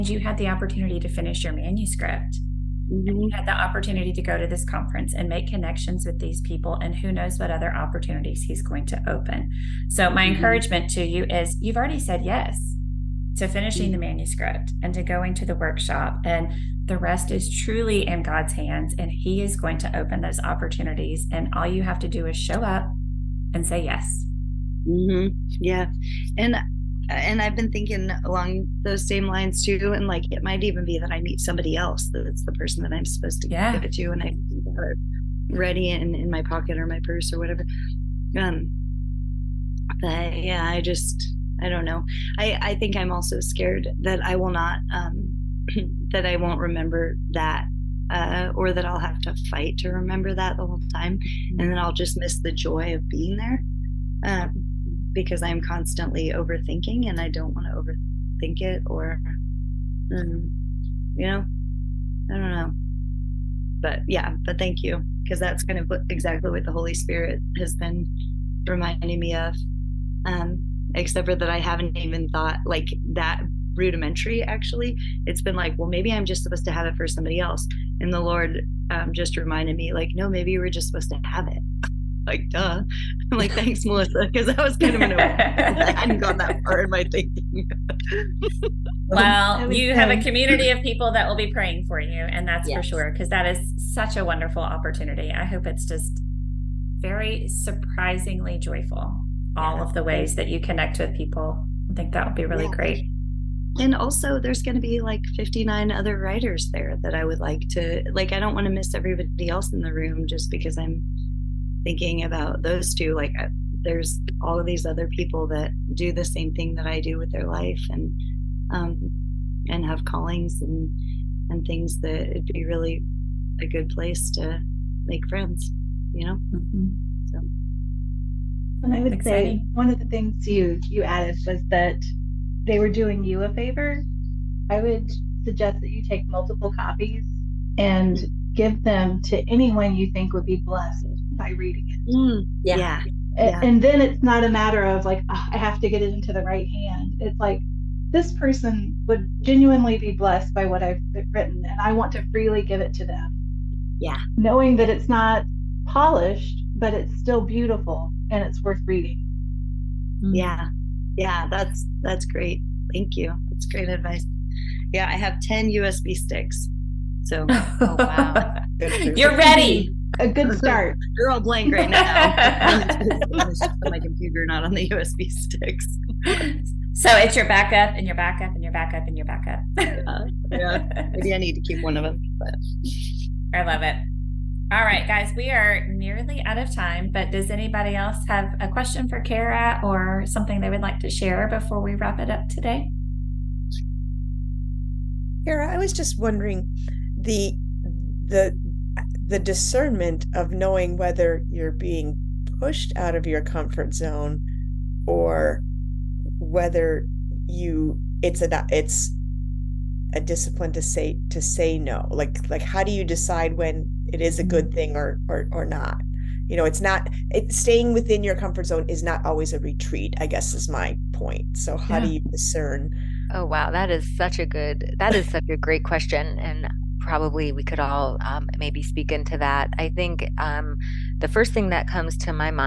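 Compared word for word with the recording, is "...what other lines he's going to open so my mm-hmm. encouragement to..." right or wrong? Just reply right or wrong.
wrong.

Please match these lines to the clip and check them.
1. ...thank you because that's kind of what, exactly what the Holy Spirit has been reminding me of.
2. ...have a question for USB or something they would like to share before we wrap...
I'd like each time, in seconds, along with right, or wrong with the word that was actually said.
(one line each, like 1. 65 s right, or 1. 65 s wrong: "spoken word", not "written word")
1. 64 s right
2. 188 s wrong: "Cara", not "USB".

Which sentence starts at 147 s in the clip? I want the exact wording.
It's like, this person would genuinely be blessed by what I've written, and I want to freely give it to them.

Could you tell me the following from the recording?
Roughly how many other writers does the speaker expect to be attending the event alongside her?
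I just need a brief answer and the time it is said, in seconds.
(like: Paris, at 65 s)
59, at 105 s.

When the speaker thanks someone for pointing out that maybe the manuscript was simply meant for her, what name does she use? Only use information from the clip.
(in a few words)
Melissa.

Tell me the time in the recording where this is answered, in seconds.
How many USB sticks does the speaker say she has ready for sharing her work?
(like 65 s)
165 s.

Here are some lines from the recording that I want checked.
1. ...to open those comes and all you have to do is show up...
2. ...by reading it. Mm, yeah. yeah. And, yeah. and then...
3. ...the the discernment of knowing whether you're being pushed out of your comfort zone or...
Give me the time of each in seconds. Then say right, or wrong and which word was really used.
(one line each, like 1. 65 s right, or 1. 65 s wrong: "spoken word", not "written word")
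1. 19 s wrong: "opportunities", not "comes"
2. 141 s right
3. 198 s right.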